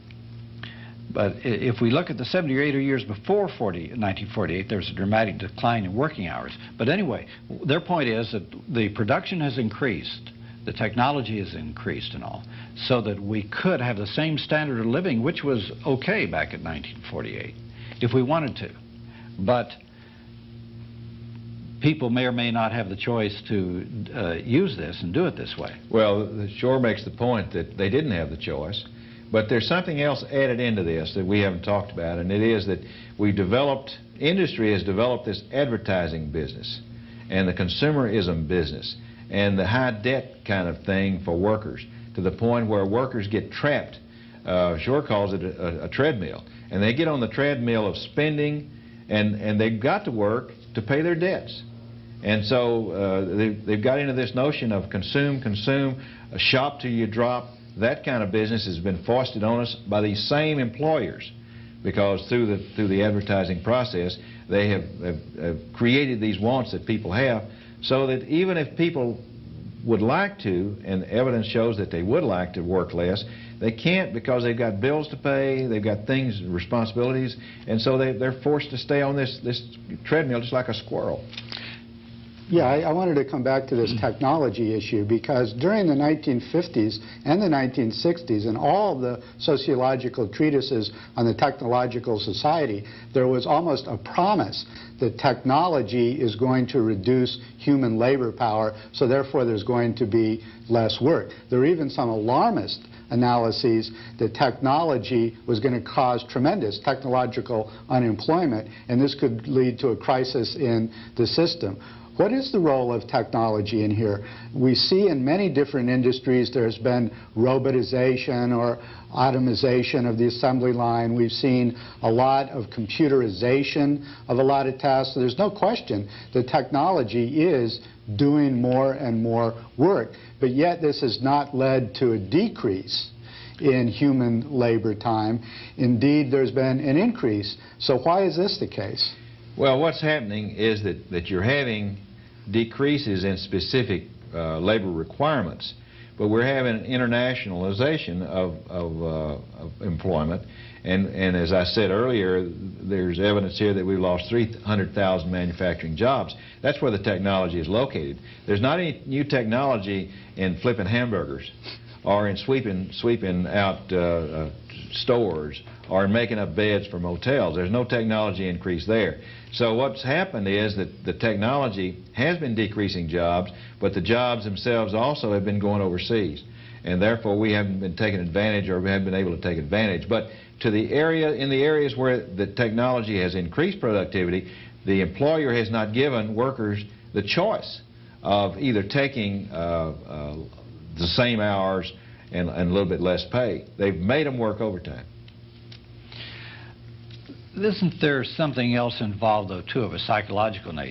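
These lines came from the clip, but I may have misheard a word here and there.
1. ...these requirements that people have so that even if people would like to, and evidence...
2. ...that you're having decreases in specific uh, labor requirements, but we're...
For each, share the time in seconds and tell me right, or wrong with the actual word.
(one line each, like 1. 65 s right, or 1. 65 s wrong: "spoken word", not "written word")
1. 66 s wrong: "wants", not "requirements"
2. 141 s right.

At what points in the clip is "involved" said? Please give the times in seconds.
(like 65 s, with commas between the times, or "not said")
198 s.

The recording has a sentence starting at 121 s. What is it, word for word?
We've seen a lot of computerization of a lot of tasks.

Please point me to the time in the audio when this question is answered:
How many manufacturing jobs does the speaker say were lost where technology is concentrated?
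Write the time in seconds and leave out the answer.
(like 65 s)
154 s.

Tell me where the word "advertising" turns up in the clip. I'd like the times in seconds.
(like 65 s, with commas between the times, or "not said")
35 s, 63 s.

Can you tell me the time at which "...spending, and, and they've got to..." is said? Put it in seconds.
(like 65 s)
47 s.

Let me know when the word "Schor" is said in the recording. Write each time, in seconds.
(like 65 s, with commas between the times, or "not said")
26 s, 44 s.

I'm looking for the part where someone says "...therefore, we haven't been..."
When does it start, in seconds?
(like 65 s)
177 s.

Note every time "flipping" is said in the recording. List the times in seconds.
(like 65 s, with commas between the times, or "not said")
160 s.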